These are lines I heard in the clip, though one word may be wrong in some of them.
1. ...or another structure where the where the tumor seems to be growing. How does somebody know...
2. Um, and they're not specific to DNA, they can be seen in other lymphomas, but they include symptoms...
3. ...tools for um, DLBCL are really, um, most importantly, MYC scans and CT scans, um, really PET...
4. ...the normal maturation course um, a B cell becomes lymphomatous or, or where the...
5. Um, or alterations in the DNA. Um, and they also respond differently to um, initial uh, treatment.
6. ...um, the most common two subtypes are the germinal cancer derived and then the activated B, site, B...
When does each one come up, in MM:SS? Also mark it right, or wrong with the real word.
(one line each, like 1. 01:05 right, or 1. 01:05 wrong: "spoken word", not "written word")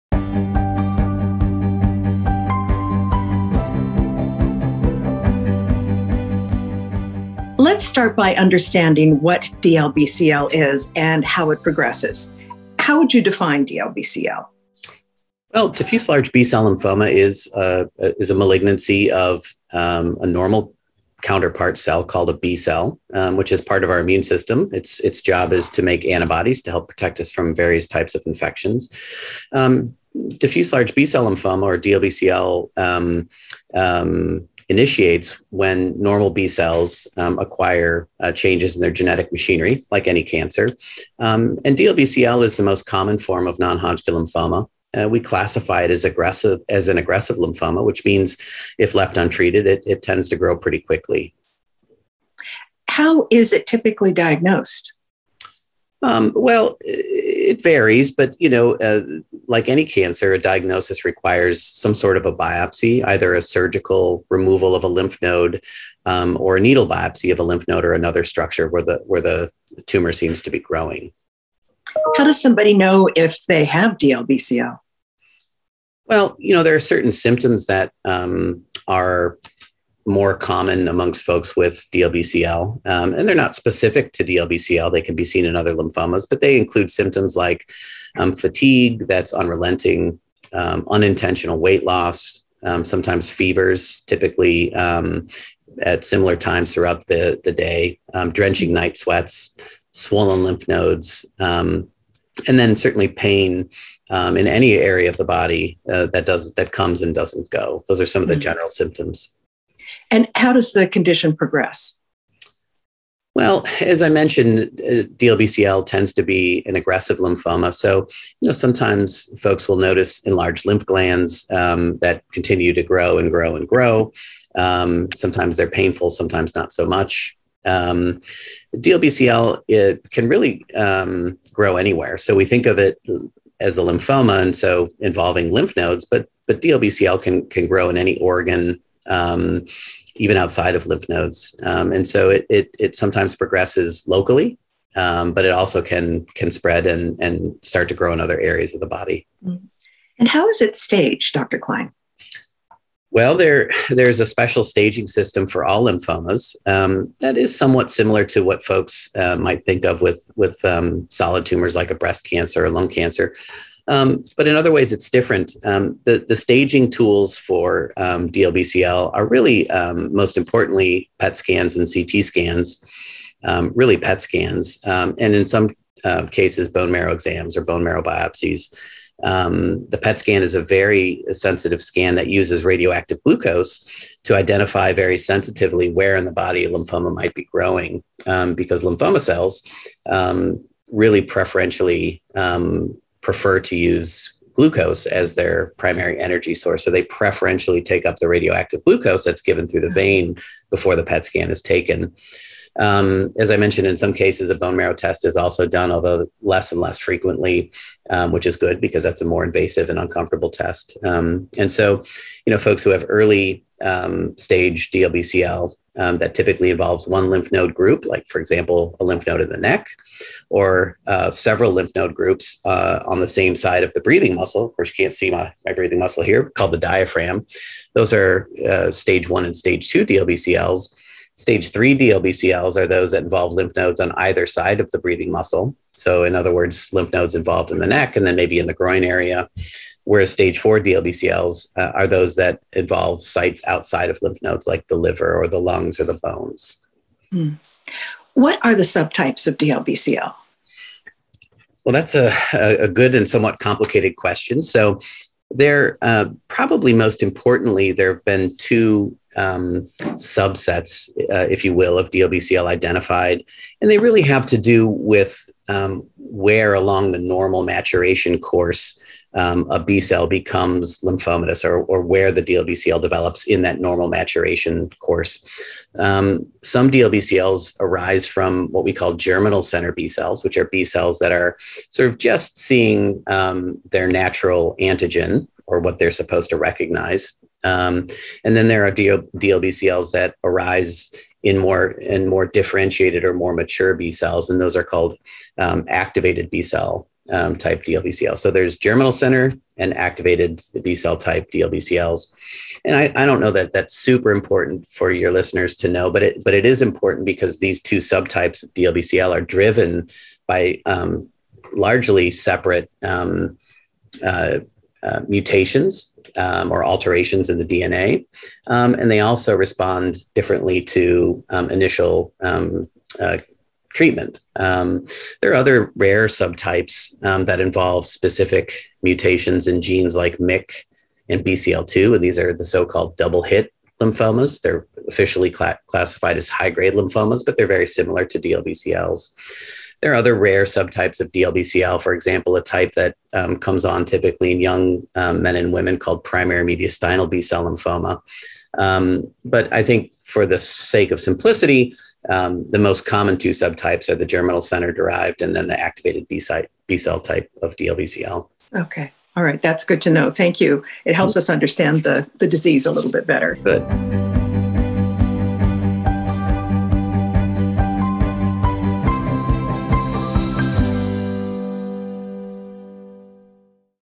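1. 01:07 right
2. 01:22 wrong: "DLBCL", not "DNA"
3. 02:46 wrong: "PET", not "MYC"
4. 04:27 right
5. 05:16 right
6. 05:52 wrong: "center", not "cancer".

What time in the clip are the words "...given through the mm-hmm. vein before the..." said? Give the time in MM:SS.
03:19.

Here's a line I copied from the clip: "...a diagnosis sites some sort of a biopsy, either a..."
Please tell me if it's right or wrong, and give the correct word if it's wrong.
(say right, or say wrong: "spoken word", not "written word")
wrong: "requires", not "sites".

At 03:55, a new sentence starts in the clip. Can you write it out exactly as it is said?
So, in other words, lymph nodes involved in the neck and then maybe in the groin area.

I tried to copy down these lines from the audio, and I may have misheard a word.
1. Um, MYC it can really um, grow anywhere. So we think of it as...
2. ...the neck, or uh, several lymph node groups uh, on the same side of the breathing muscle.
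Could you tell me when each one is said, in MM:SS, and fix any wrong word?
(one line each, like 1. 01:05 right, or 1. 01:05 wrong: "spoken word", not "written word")
1. 02:07 wrong: "DLBCL", not "MYC"
2. 03:39 right.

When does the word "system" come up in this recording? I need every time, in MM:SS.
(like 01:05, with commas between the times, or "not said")
00:24, 02:35.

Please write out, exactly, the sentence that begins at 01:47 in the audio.
Those are some of the mm-hmm.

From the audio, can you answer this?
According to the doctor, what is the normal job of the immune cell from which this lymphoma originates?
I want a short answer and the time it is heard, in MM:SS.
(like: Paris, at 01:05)
make antibodies, at 00:25.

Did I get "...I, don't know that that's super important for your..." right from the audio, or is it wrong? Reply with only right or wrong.
right.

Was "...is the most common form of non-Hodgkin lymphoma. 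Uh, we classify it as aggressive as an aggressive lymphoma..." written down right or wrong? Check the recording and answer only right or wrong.
right.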